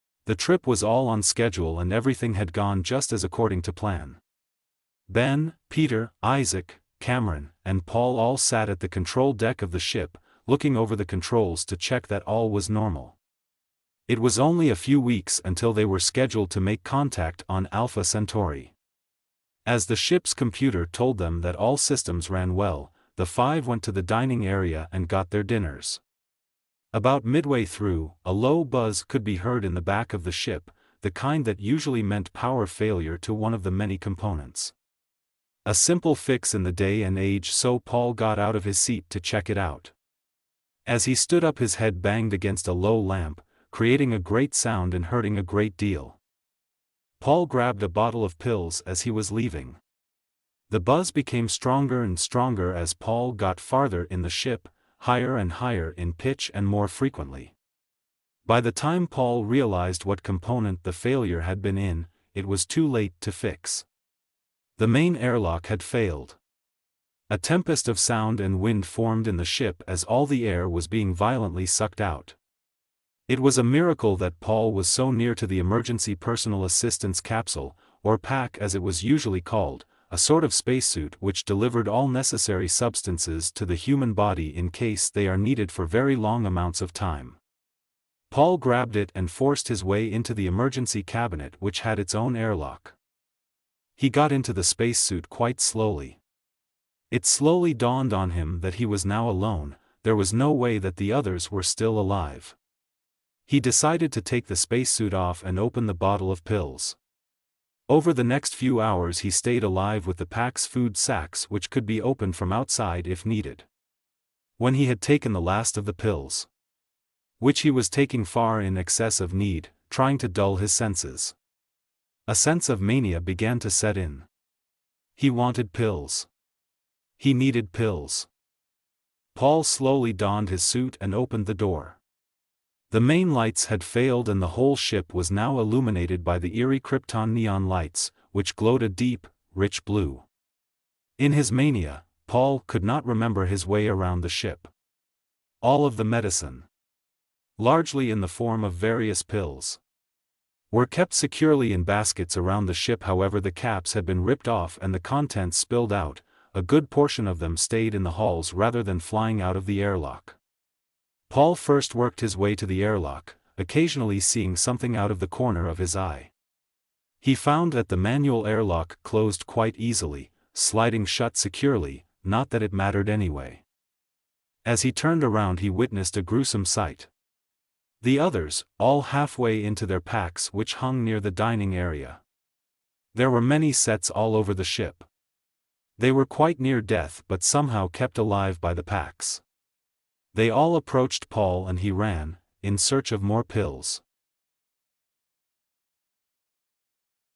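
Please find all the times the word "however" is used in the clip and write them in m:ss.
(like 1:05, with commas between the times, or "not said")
2:33.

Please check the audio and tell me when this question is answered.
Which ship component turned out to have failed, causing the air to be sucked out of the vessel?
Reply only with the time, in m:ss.
1:04.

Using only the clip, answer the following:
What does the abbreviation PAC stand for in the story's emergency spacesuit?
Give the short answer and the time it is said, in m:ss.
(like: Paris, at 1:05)
Personal assistance capsule, at 1:16.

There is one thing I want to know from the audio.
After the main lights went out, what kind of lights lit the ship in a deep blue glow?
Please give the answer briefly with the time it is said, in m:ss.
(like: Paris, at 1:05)
Krypton neon lights, at 2:16.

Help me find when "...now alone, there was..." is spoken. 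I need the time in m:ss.
1:39.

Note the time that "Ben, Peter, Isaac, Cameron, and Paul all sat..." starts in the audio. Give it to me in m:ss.
0:05.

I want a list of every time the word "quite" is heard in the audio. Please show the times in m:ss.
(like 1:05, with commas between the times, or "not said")
1:35, 2:49, 3:06.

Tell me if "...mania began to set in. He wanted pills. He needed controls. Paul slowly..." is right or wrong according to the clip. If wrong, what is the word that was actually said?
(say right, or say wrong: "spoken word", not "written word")
wrong: "pills", not "controls".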